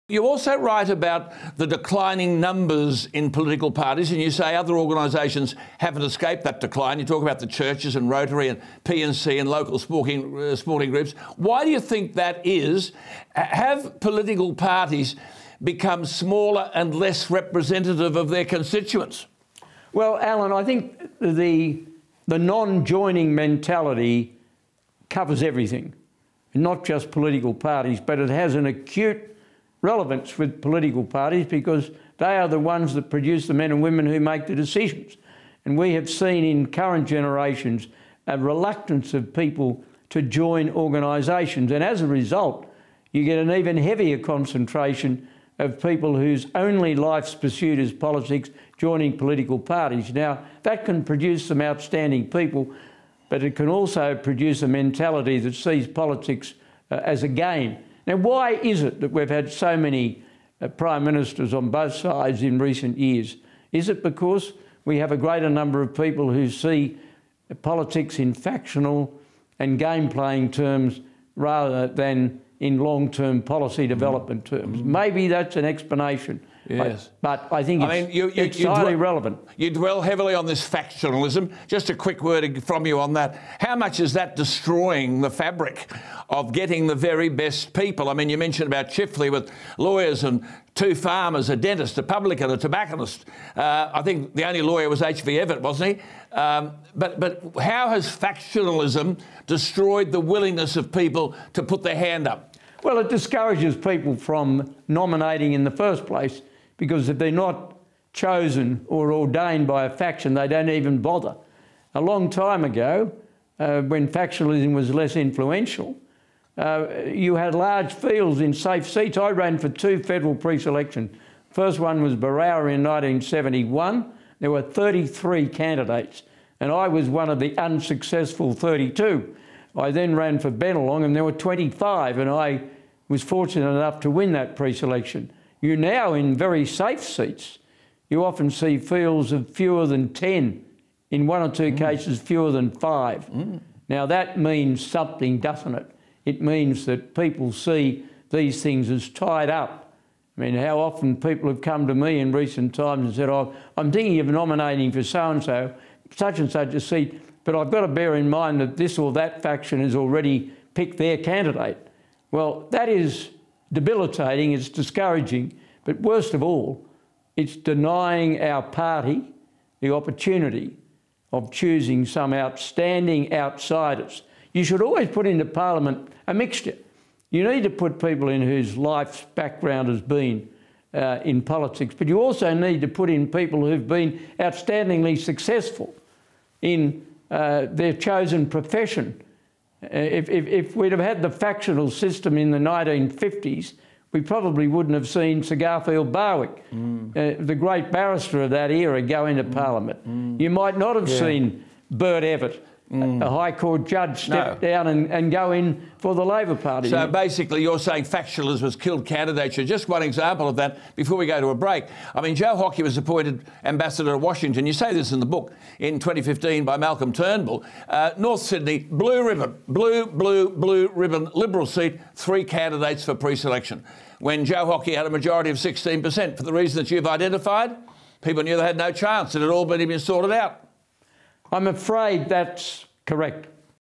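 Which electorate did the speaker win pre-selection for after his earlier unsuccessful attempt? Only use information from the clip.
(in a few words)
Bennelong.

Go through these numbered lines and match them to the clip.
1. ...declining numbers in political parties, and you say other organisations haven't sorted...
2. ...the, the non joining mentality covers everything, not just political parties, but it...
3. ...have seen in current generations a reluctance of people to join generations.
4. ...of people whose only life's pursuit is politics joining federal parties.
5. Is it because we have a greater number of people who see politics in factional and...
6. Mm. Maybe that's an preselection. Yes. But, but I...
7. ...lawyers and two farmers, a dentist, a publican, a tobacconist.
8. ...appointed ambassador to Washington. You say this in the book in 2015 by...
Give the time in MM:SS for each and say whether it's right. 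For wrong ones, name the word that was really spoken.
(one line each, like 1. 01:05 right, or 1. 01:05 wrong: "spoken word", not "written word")
1. 00:01 wrong: "escaped", not "sorted"
2. 00:21 right
3. 00:35 wrong: "organisations", not "generations"
4. 00:45 wrong: "political", not "federal"
5. 01:03 right
6. 01:14 wrong: "explanation", not "preselection"
7. 01:29 right
8. 03:32 right.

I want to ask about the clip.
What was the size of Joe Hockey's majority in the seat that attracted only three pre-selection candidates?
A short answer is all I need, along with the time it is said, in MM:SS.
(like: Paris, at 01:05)
16%, at 03:45.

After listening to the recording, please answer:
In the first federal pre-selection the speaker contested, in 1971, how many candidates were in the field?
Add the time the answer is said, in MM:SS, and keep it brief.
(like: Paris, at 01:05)
33, at 02:04.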